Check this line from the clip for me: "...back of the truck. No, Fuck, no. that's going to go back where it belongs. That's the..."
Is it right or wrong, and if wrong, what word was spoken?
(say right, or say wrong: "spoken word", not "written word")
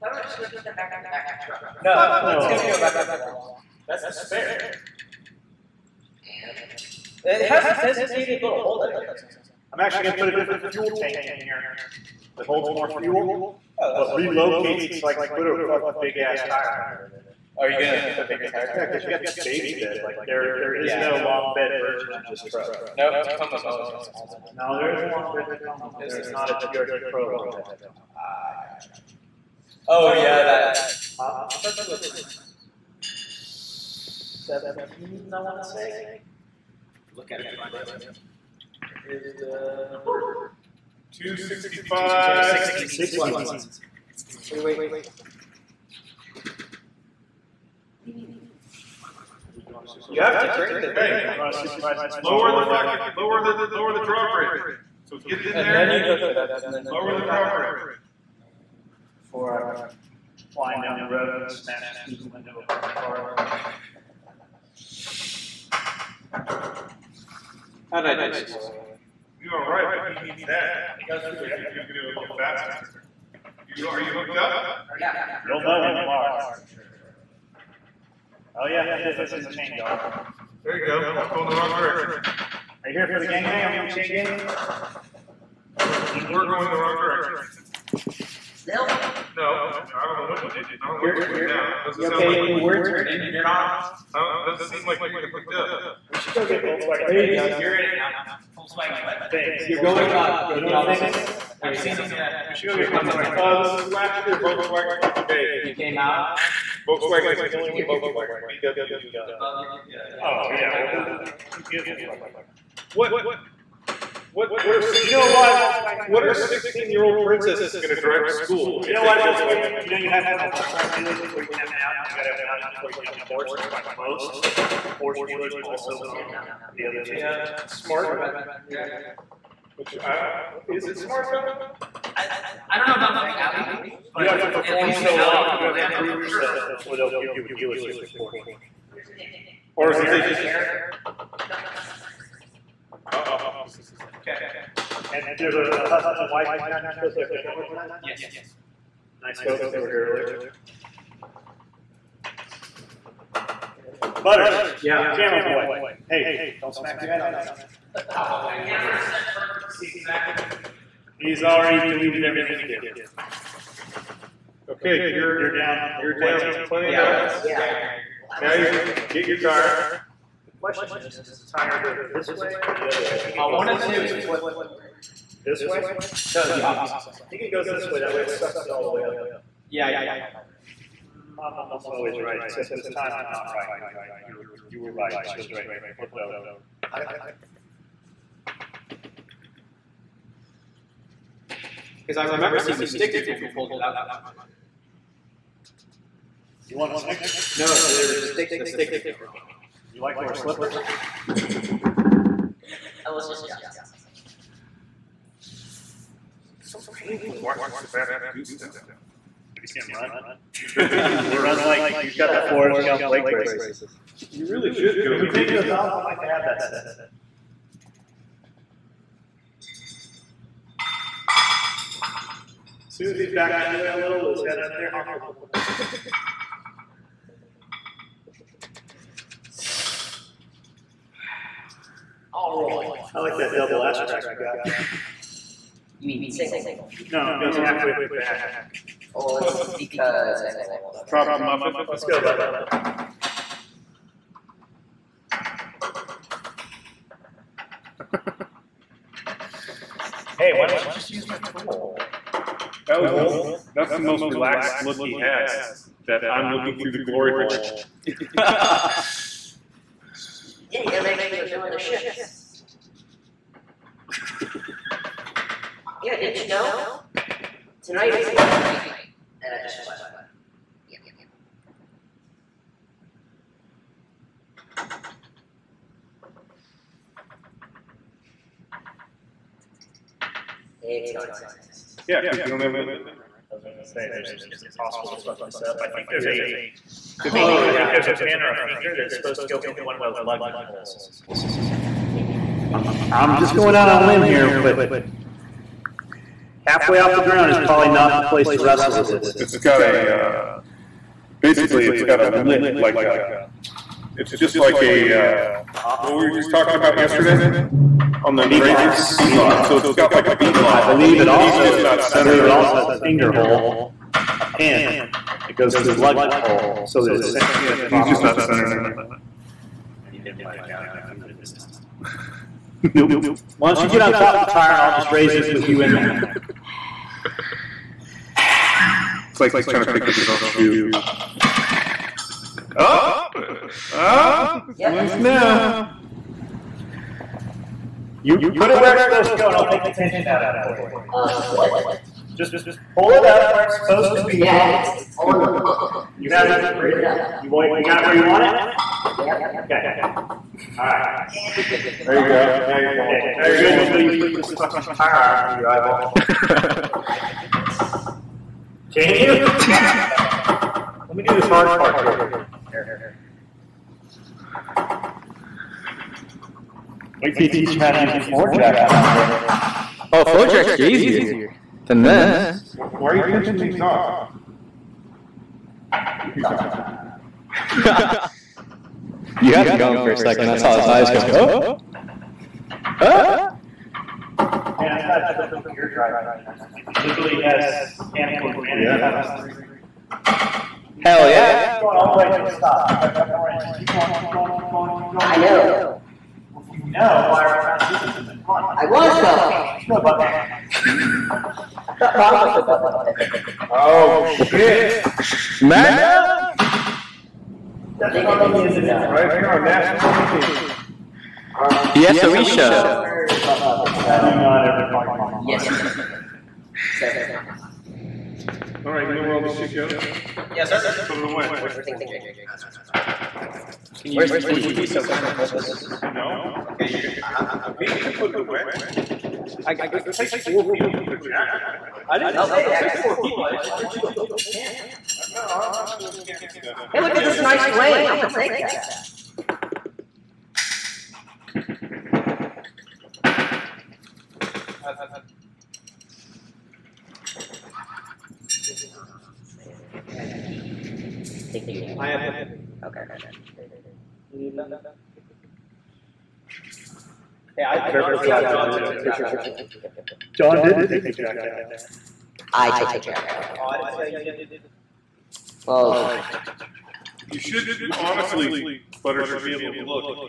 right.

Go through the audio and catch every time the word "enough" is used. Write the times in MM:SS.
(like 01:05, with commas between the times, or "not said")
02:47, 05:20.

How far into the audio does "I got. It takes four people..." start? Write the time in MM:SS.
07:09.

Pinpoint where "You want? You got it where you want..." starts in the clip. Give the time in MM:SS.
05:47.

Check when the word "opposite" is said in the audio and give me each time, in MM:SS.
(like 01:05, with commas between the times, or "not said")
01:41, 02:56.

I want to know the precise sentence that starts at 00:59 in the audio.
Before I'm flying down the road and it smashes through the window of one of my cars.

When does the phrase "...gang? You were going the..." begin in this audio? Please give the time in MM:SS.
01:24.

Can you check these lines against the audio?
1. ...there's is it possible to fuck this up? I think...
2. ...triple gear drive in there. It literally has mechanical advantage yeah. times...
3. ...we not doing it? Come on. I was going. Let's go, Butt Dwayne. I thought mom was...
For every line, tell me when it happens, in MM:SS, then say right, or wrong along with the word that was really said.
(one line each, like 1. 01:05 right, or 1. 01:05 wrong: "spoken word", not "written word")
1. 04:44 right
2. 06:25 right
3. 06:37 wrong: "Puppet", not "Dwayne".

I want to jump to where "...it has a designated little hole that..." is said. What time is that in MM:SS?
00:07.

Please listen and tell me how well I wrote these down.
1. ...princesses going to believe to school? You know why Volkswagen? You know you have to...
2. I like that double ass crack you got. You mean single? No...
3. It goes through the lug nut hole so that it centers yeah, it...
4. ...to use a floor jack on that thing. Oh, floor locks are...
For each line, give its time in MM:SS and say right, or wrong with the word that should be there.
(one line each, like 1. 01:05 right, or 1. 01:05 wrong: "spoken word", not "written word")
1. 01:57 wrong: "drive", not "believe"
2. 03:53 right
3. 05:15 right
4. 06:07 wrong: "jacks", not "locks".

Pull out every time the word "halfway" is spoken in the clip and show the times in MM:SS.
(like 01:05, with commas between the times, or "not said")
03:57, 04:56.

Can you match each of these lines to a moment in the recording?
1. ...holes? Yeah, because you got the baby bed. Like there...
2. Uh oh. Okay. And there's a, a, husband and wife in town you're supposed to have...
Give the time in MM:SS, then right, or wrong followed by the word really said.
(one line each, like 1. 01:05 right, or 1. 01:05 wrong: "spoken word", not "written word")
1. 00:18 wrong: "tires", not "holes"
2. 02:21 right.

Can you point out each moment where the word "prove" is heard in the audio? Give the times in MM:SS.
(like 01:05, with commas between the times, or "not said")
02:15.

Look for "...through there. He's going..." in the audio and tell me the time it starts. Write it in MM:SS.
01:11.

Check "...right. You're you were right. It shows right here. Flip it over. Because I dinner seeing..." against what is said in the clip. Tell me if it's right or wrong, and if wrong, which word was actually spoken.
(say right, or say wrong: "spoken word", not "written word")
wrong: "remember", not "dinner".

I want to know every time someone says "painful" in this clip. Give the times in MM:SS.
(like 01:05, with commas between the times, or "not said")
03:26.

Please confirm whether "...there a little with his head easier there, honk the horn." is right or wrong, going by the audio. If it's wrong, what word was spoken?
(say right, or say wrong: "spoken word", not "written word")
wrong: "under", not "easier".